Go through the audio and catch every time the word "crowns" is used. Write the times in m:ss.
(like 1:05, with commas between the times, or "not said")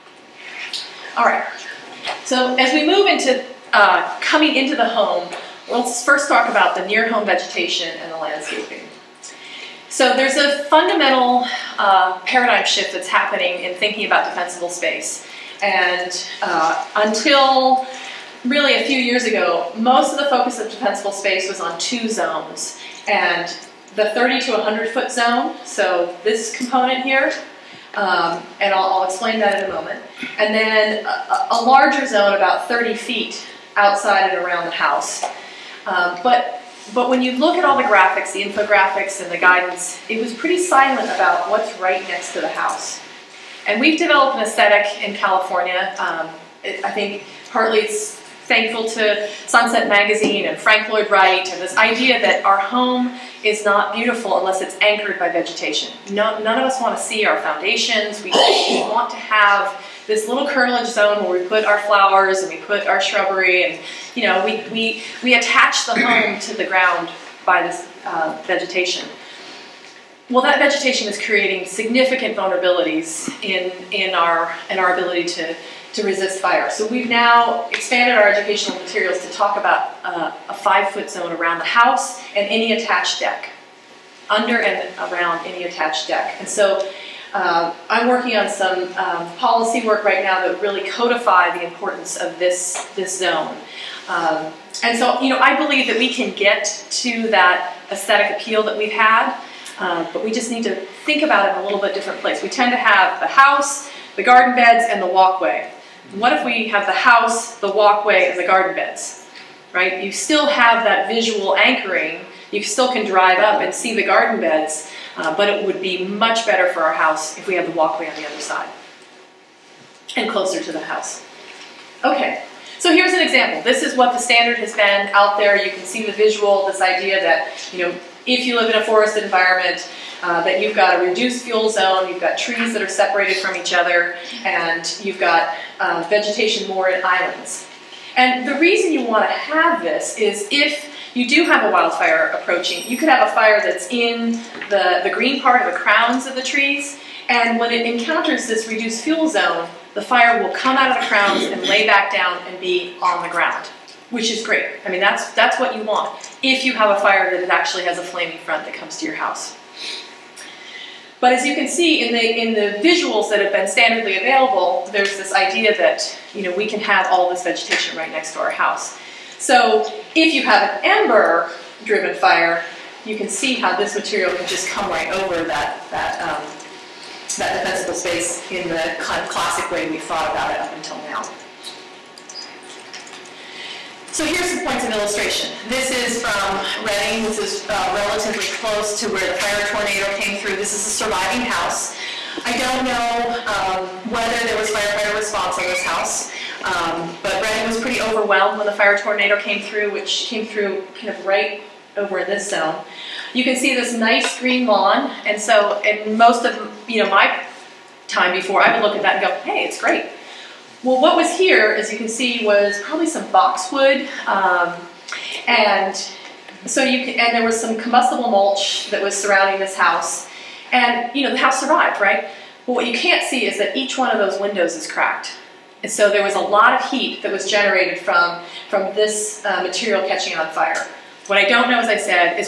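2:25, 2:31.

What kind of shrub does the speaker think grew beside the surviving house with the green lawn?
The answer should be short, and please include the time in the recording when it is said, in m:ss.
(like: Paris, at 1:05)
boxwood, at 3:33.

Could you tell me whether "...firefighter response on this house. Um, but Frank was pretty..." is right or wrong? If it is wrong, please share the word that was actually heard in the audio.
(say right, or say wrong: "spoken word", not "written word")
wrong: "Redding", not "Frank".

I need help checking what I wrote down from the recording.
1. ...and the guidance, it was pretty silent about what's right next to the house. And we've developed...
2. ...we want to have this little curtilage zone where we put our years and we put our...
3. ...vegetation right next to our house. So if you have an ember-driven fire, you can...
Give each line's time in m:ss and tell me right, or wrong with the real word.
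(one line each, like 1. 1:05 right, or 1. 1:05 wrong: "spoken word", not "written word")
1. 0:39 right
2. 0:58 wrong: "flowers", not "years"
3. 2:47 right.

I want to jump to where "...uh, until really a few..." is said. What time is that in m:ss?
0:16.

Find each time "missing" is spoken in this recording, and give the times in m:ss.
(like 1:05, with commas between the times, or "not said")
not said.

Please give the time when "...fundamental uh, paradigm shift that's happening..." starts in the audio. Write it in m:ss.
0:10.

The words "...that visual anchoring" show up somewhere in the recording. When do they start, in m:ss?
1:50.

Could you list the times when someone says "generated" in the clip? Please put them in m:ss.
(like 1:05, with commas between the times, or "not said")
3:47.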